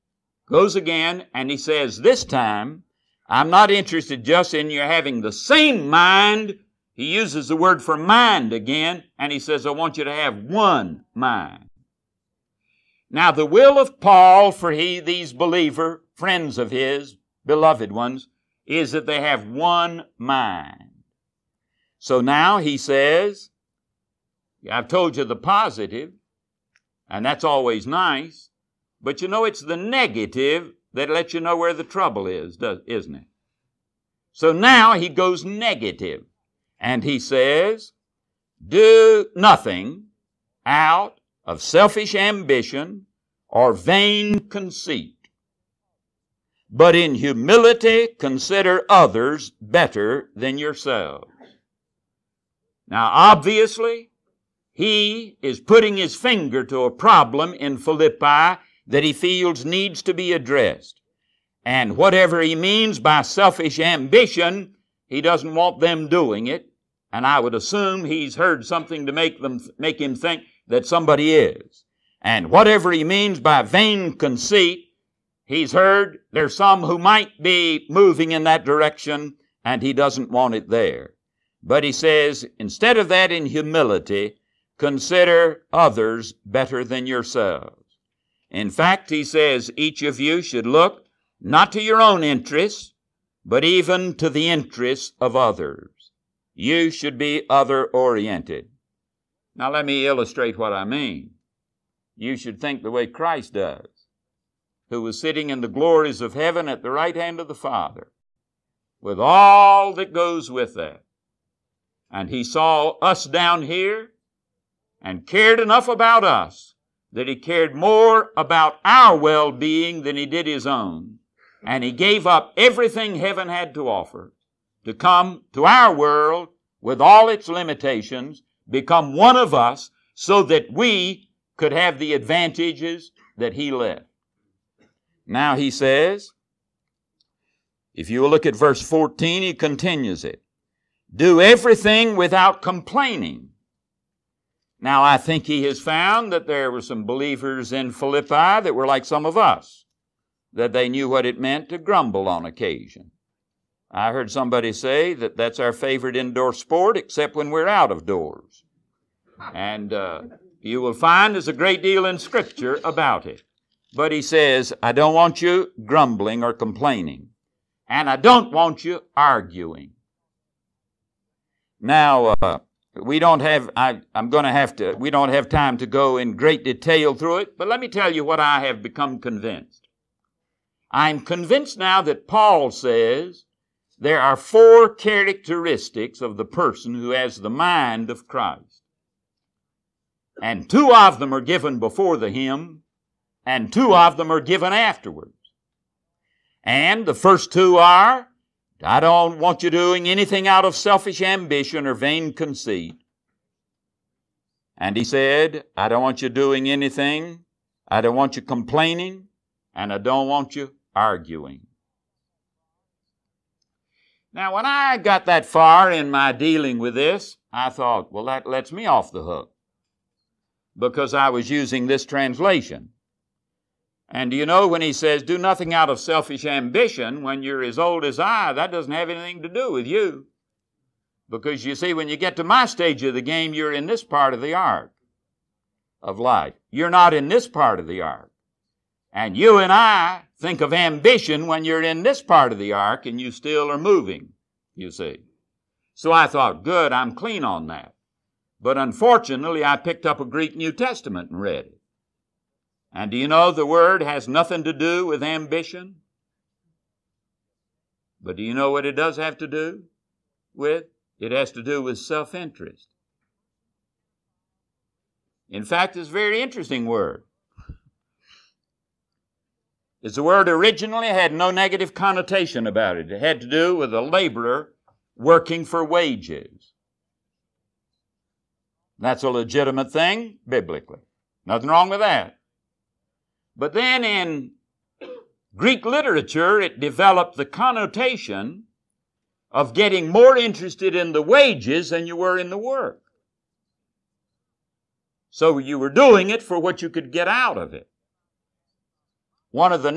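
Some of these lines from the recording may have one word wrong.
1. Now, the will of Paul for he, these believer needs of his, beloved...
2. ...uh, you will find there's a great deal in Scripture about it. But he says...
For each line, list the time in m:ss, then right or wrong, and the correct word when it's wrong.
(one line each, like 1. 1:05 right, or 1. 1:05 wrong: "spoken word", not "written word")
1. 0:13 wrong: "friends", not "needs"
2. 2:39 right.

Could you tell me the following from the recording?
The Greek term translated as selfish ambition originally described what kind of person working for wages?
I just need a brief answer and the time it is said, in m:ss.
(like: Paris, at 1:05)
a laborer, at 4:33.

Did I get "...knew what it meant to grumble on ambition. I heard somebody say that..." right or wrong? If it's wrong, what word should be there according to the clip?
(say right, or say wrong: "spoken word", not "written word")
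wrong: "occasion", not "ambition".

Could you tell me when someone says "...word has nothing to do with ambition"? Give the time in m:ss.
4:13.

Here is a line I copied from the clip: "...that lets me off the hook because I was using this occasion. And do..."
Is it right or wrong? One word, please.
wrong.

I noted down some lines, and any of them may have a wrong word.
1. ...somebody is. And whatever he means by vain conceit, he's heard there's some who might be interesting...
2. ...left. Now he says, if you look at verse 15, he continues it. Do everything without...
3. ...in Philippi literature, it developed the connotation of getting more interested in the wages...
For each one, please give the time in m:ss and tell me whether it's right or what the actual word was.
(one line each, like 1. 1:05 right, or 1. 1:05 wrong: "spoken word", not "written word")
1. 1:10 wrong: "moving", not "interesting"
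2. 2:13 wrong: "14", not "15"
3. 4:44 wrong: "Greek", not "Philippi".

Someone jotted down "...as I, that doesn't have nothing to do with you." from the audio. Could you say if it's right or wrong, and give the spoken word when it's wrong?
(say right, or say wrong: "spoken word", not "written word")
wrong: "anything", not "nothing".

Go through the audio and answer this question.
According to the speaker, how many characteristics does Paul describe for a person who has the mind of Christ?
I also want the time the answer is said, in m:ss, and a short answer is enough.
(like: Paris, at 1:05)
4, at 3:04.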